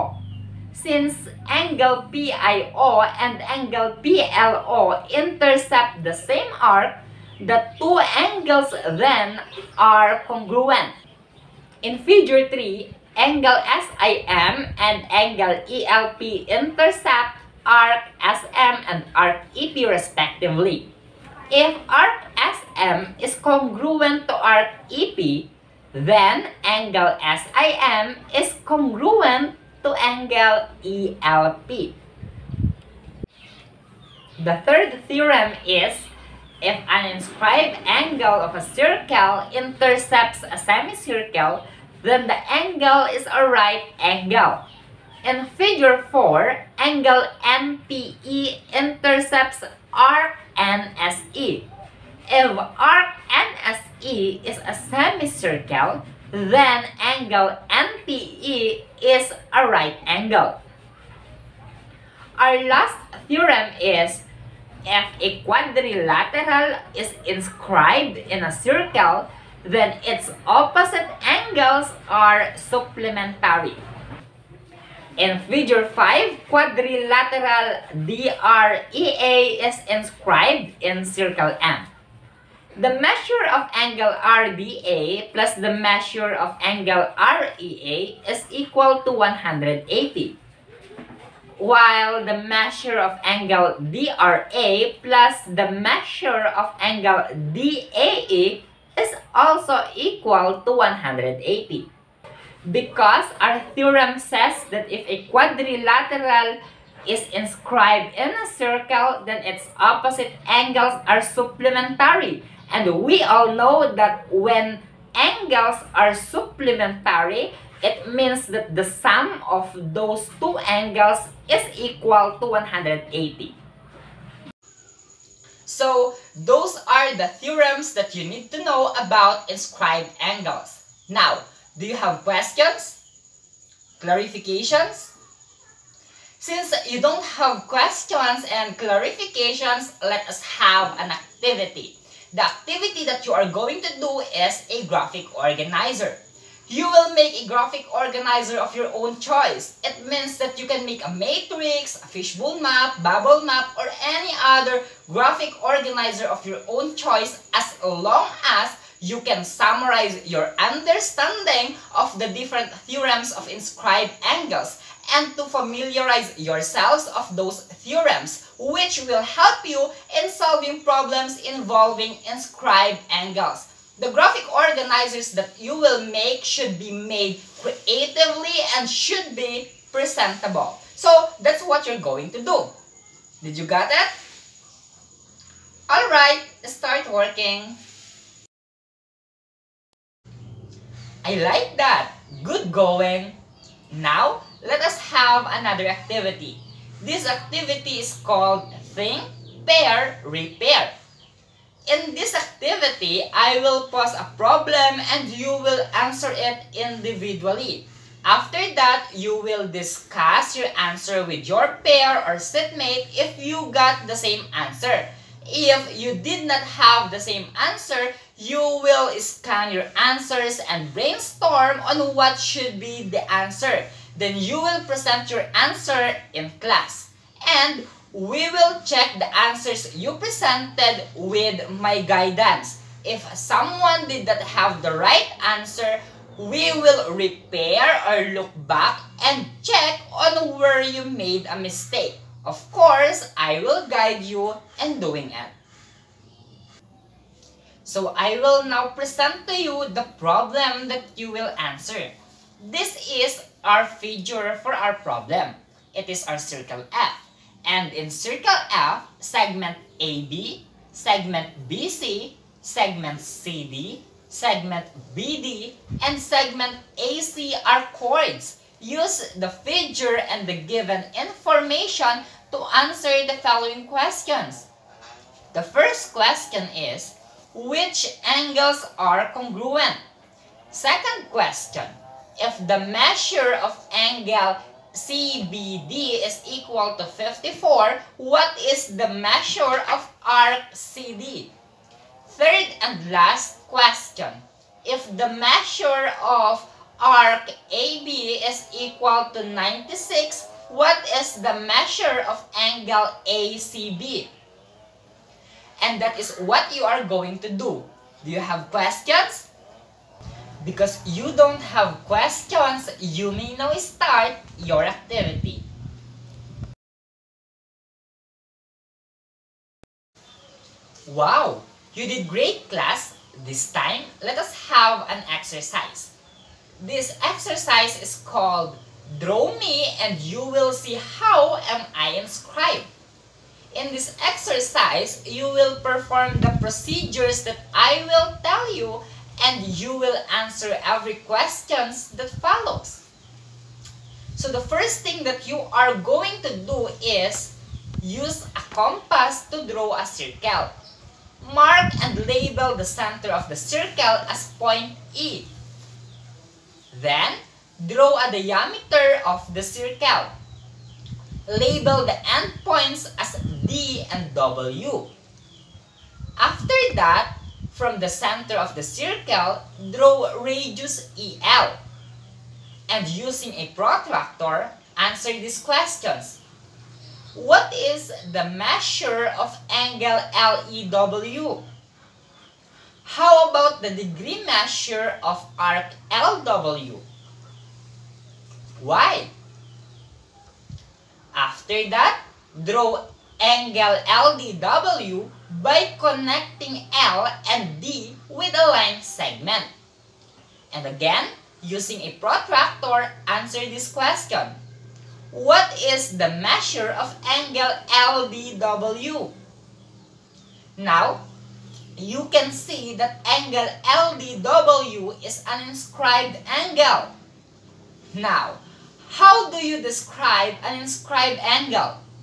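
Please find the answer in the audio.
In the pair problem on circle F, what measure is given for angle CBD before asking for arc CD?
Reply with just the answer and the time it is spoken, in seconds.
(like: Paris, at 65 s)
54, at 287 s.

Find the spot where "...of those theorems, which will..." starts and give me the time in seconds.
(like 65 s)
167 s.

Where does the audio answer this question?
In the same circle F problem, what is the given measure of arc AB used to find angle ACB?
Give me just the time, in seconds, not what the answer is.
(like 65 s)
299 s.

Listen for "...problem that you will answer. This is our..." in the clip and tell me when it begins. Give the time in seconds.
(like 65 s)
250 s.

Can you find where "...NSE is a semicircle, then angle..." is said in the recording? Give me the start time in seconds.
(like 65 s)
53 s.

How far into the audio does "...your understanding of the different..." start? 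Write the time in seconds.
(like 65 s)
160 s.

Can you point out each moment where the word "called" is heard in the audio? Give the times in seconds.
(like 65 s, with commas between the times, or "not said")
198 s, 328 s.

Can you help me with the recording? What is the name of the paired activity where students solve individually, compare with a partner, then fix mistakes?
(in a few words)
Think, Pair, Repair.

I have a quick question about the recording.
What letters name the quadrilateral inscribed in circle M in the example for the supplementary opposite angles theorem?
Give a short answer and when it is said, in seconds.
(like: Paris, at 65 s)
DREA, at 76 s.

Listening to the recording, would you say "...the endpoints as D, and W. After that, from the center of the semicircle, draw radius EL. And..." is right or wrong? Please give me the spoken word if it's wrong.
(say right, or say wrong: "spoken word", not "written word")
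wrong: "circle", not "semicircle".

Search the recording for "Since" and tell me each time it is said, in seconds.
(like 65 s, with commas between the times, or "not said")
0 s, 136 s.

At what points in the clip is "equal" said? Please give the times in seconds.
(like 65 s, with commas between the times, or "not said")
88 s, 99 s, 121 s, 286 s, 298 s.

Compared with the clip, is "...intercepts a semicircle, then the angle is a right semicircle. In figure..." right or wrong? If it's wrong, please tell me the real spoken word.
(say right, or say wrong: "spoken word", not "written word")
wrong: "angle", not "semicircle".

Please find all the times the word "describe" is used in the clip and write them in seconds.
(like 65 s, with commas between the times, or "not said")
419 s.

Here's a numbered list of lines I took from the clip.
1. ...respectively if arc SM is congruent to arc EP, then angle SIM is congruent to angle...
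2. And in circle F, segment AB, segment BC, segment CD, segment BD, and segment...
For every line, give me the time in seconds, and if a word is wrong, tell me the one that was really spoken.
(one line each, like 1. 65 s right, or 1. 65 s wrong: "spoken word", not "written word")
1. 19 s right
2. 257 s right.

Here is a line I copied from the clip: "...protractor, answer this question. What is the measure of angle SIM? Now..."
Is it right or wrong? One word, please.
wrong.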